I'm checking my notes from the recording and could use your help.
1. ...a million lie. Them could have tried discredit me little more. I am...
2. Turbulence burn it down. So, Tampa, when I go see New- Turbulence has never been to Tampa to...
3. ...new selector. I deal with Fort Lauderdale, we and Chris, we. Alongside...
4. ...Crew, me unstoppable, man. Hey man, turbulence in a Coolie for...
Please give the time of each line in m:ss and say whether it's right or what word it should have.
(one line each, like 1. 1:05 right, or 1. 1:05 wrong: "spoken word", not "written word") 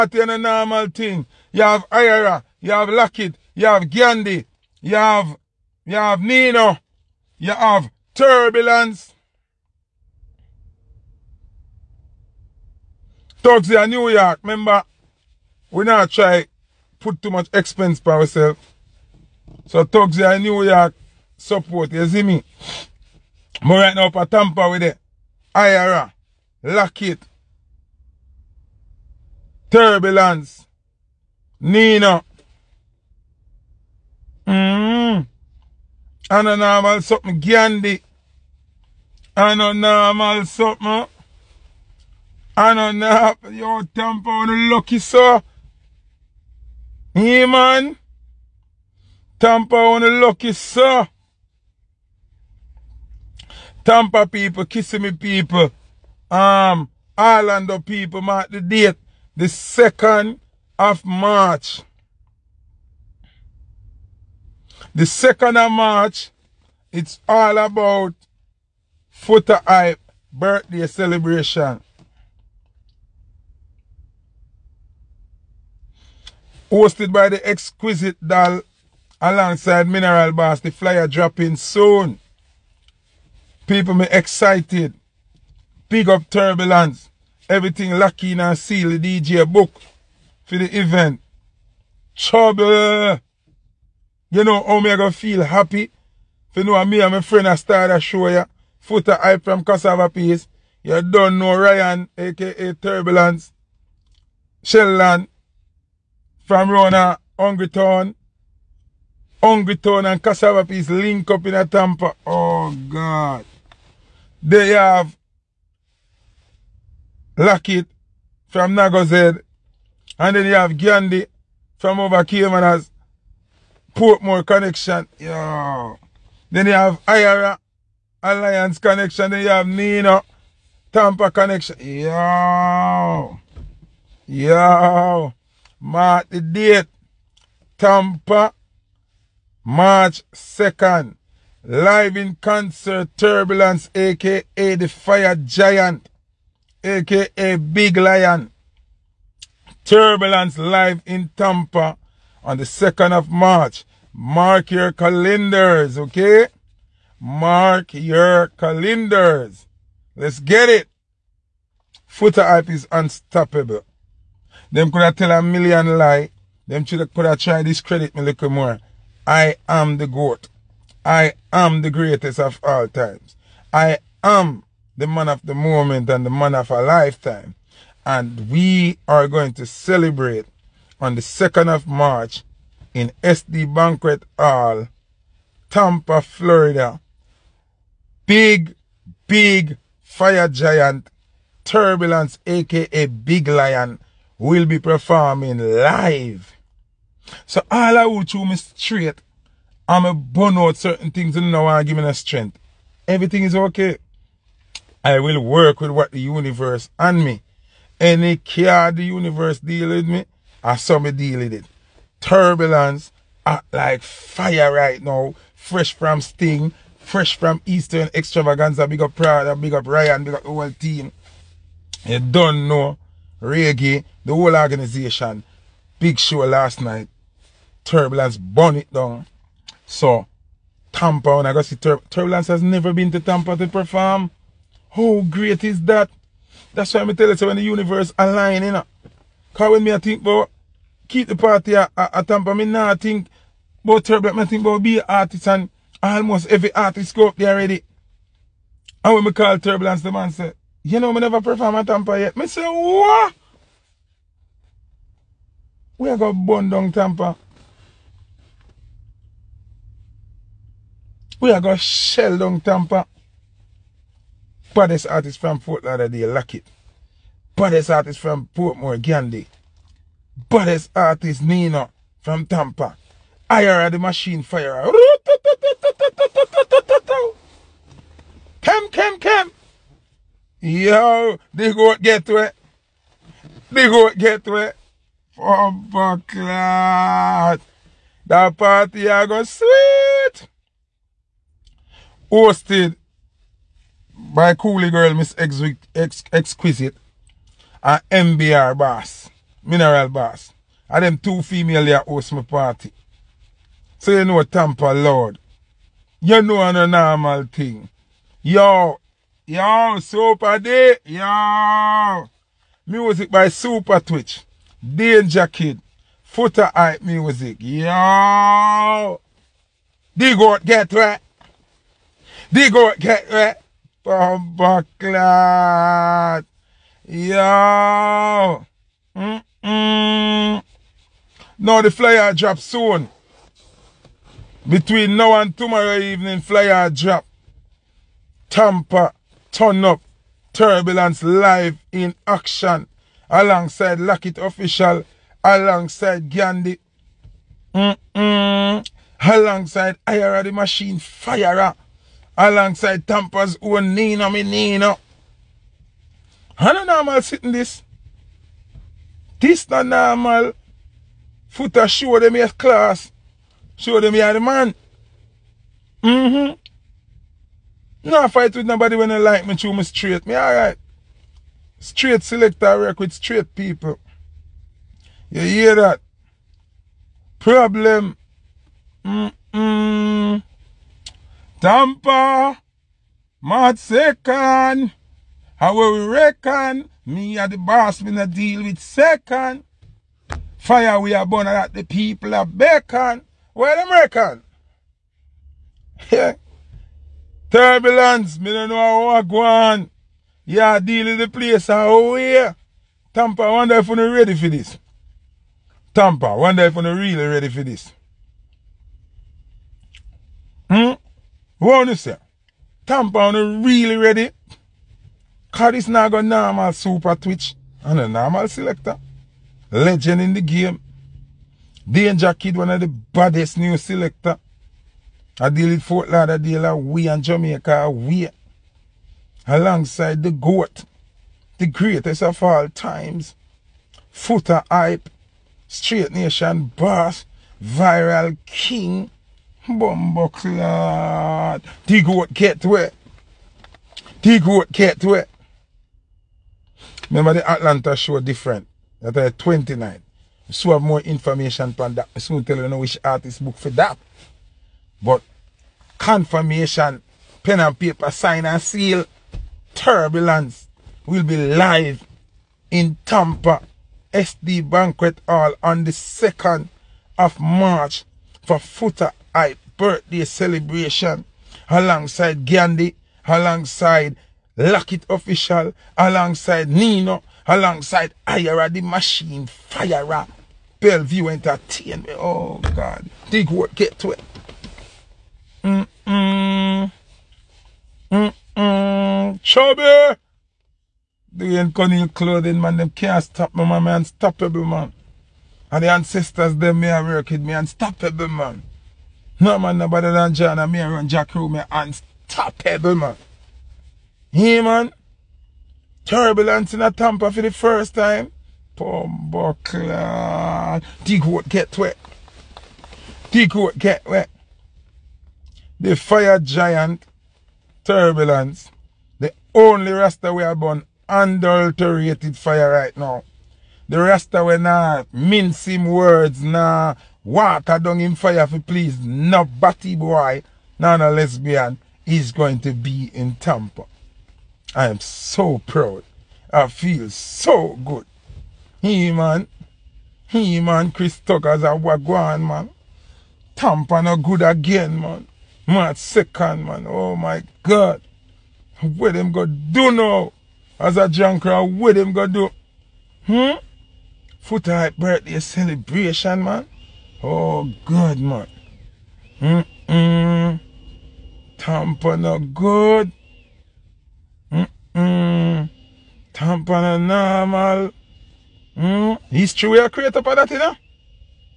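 1. 2:45 right
2. 3:47 wrong: "Tur", not "New"
3. 7:03 wrong: "Jamaica", not "Chris"
4. 8:21 wrong: "Tampa", not "Coolie".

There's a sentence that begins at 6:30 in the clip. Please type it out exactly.
Fire we are born at the people of Bacon.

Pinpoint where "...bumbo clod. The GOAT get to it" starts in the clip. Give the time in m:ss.
7:19.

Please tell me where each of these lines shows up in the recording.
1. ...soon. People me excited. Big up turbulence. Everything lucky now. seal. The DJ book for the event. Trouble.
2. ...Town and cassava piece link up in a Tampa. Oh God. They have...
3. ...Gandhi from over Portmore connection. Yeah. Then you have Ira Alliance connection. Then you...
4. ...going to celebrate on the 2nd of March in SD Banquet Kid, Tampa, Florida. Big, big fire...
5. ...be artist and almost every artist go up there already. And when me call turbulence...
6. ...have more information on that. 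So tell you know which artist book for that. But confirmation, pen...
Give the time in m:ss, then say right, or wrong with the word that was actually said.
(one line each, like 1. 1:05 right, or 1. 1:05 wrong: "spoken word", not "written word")
1. 1:21 right
2. 1:49 right
3. 2:00 right
4. 2:59 wrong: "Hall", not "Kid"
5. 4:04 right
6. 7:30 right.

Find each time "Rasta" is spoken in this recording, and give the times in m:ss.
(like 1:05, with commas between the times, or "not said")
8:39, 8:43.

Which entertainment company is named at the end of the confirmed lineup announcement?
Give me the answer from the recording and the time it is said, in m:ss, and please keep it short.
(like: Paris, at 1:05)
Bellevue Entertainment, at 8:00.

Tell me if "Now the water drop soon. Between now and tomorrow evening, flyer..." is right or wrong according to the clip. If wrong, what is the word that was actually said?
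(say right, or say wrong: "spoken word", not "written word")
wrong: "flyer", not "water".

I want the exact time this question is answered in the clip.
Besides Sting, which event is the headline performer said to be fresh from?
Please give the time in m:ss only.
3:36.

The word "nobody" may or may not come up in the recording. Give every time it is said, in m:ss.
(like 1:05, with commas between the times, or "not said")
6:08, 8:19, 8:49.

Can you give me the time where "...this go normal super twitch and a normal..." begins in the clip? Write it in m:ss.
6:55.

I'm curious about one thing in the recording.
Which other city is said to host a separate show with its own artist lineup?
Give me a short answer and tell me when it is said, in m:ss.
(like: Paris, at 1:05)
Atlanta, at 7:27.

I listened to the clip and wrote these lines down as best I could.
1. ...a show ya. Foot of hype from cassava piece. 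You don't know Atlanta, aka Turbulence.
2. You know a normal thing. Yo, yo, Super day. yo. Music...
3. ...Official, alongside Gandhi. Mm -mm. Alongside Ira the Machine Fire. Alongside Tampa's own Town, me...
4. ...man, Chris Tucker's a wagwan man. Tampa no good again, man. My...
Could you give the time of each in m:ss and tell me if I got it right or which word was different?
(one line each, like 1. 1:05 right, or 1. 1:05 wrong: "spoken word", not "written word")
1. 1:37 wrong: "Ryan", not "Atlanta"
2. 5:06 right
3. 5:44 wrong: "Nina", not "Town"
4. 9:00 right.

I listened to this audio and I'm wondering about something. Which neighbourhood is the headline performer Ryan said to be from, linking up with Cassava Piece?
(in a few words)
Hungry Town.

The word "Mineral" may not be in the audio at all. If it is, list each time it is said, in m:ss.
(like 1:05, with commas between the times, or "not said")
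1:19, 4:59.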